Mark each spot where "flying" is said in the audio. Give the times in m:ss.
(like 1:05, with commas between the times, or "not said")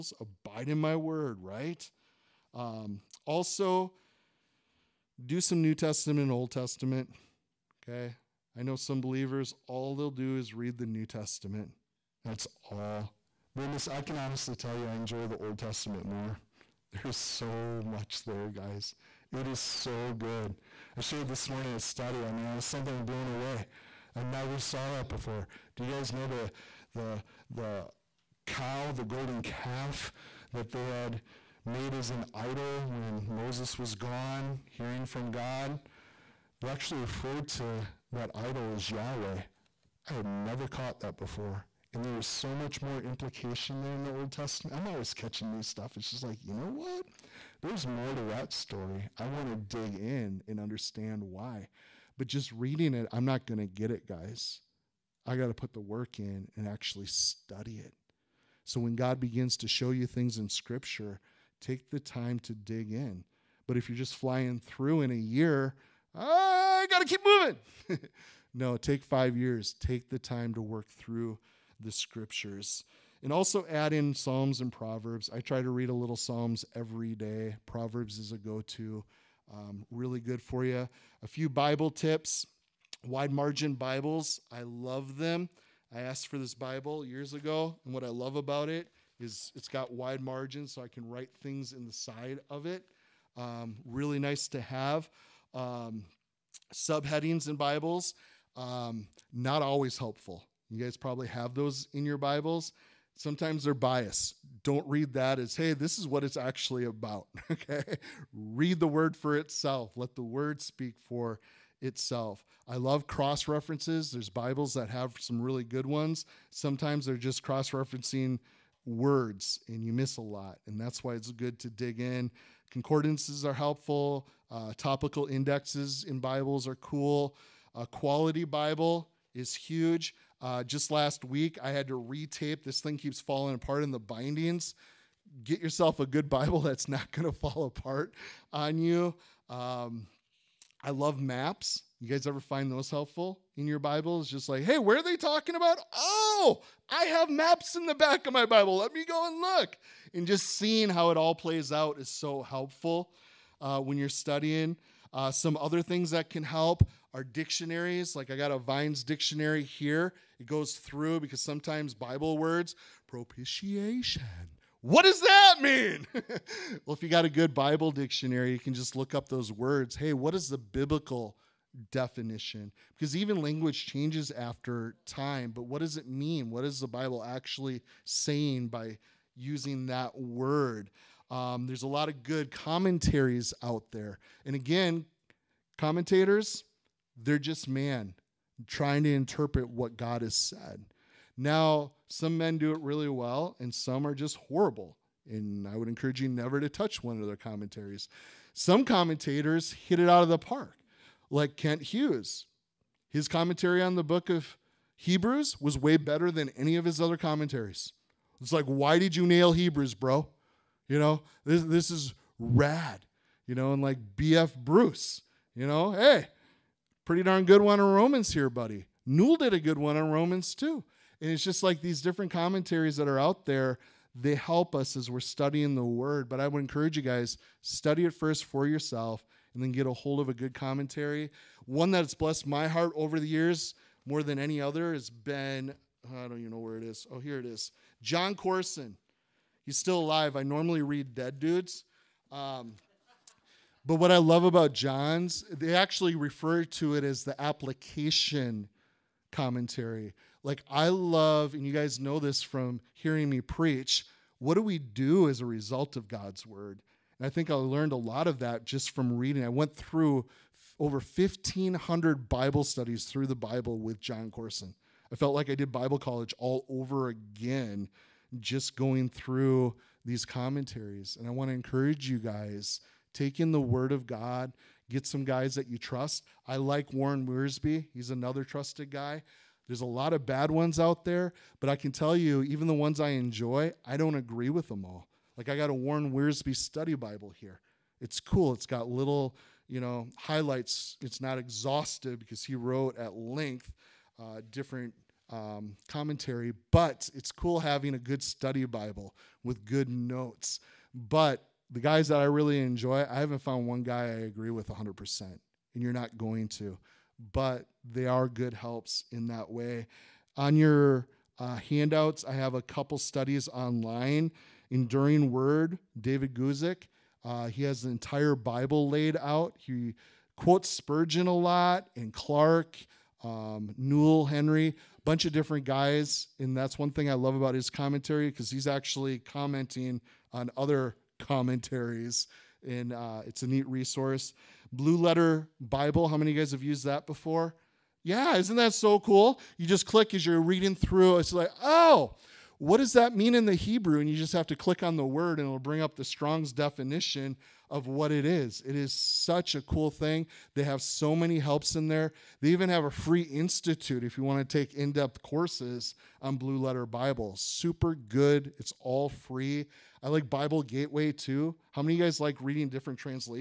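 1:04.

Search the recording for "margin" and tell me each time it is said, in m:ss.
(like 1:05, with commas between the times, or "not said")
1:23, 1:30.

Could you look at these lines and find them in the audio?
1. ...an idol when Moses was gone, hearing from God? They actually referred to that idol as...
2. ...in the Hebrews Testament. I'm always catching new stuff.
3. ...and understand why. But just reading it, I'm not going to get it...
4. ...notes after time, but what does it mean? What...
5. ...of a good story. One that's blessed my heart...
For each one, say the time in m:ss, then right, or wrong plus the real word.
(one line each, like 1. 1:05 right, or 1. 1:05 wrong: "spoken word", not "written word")
1. 0:32 right
2. 0:43 wrong: "Old", not "Hebrews"
3. 0:50 right
4. 2:53 wrong: "changes", not "notes"
5. 3:50 wrong: "commentary", not "story".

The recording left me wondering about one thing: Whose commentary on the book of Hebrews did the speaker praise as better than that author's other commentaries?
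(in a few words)
Kent Hughes.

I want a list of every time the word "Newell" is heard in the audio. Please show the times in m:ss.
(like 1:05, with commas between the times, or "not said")
3:39, 5:23.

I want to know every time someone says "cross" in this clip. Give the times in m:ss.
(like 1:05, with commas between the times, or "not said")
1:53, 1:57.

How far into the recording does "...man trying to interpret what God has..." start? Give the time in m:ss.
3:07.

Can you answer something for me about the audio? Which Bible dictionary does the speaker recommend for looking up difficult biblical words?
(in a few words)
Vine's dictionary.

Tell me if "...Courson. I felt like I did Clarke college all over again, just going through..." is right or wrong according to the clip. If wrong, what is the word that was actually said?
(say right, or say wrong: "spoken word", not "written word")
wrong: "Bible", not "Clarke".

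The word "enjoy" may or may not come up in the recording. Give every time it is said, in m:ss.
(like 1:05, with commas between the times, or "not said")
0:14, 4:43, 5:02.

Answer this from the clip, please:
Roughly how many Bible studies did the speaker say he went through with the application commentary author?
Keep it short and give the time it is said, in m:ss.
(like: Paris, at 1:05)
1,500, at 4:20.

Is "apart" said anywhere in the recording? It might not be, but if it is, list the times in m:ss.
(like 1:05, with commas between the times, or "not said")
2:13, 2:17.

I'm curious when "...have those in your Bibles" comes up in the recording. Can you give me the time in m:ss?
1:41.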